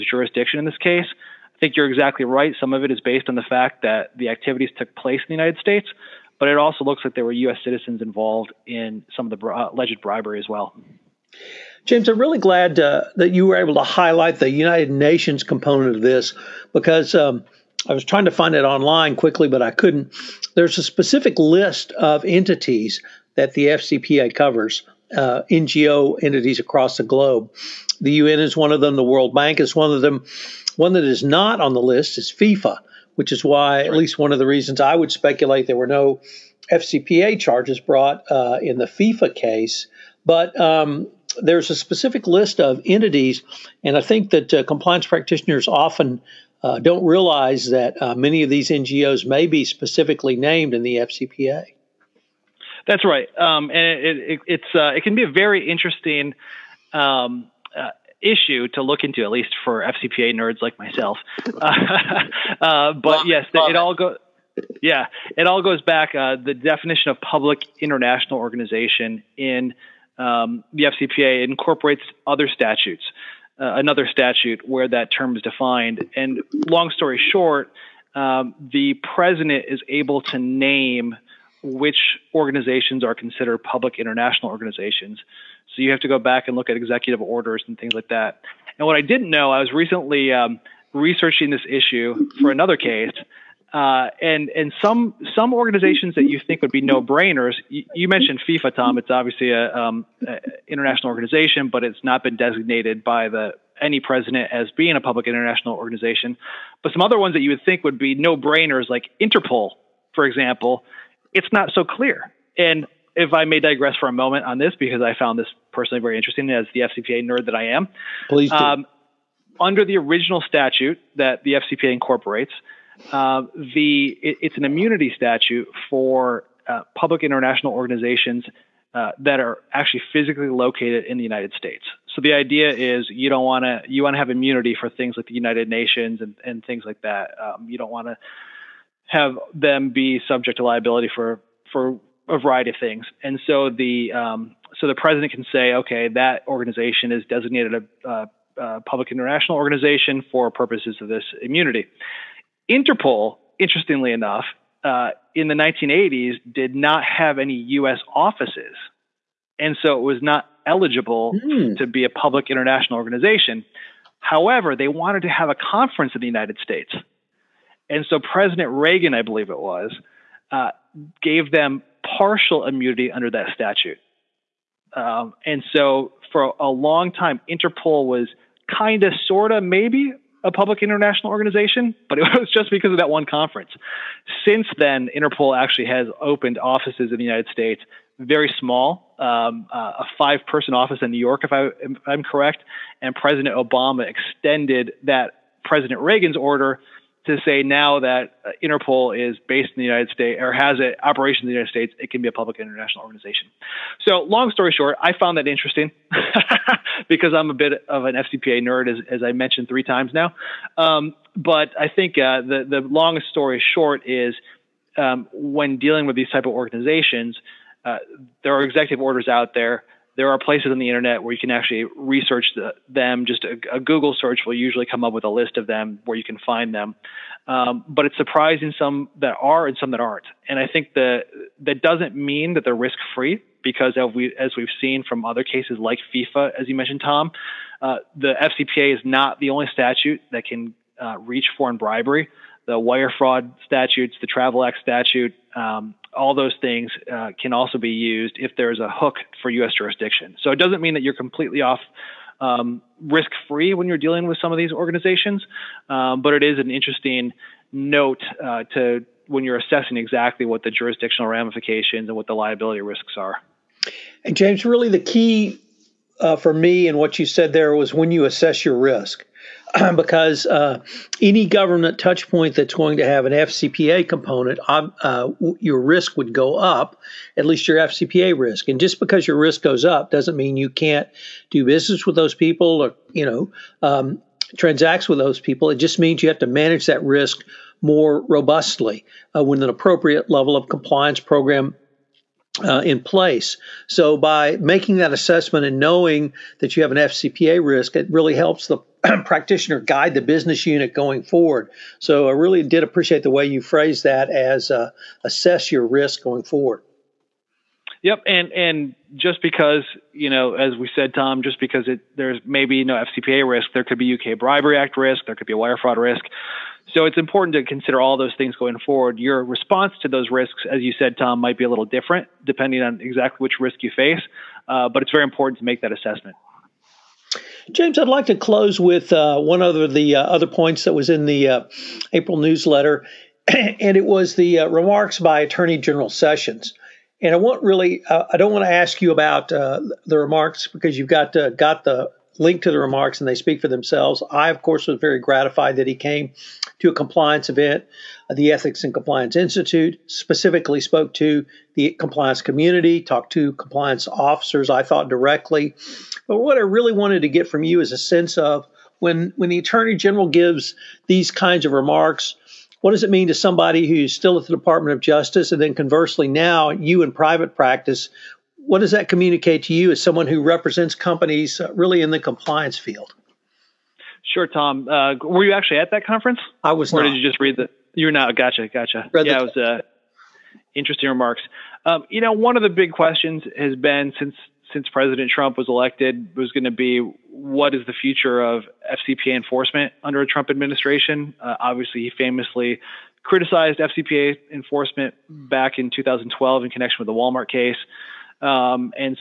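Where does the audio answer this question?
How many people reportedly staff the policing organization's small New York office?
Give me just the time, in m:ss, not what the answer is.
3:10.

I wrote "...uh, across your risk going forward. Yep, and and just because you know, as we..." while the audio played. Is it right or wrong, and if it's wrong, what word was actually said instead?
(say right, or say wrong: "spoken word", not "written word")
wrong: "assess", not "across".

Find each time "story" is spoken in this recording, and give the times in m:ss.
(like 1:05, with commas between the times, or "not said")
1:16, 3:24, 3:33.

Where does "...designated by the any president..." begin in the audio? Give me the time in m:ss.
1:42.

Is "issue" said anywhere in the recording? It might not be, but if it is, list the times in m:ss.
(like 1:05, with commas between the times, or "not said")
0:58, 1:31.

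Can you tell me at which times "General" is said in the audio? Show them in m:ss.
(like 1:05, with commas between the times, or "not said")
5:35, 5:59.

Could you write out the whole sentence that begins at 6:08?
What does that communicate to you as someone who represents companies uh, really in the compliance field?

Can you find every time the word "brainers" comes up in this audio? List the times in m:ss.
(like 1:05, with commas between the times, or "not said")
1:36, 1:48.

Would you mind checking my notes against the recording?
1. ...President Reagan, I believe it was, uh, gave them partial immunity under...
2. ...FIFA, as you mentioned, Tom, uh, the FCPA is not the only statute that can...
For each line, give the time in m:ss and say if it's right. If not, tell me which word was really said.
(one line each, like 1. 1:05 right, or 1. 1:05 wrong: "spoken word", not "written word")
1. 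2:48 right
2. 3:56 right.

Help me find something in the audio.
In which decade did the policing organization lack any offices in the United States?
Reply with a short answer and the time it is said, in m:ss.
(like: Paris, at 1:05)
1980s, at 2:35.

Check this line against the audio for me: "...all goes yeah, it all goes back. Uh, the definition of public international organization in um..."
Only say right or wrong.
right.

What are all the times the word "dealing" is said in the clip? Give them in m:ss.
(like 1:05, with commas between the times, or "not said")
3:35, 4:13.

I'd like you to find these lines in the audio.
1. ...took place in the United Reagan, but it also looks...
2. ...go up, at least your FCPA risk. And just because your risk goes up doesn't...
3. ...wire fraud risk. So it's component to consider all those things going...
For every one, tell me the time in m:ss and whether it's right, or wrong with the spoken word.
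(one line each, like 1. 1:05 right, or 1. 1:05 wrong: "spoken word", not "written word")
1. 0:04 wrong: "States", not "Reagan"
2. 4:36 right
3. 5:15 wrong: "important", not "component".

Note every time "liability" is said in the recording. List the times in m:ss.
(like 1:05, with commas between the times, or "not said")
2:20, 4:22.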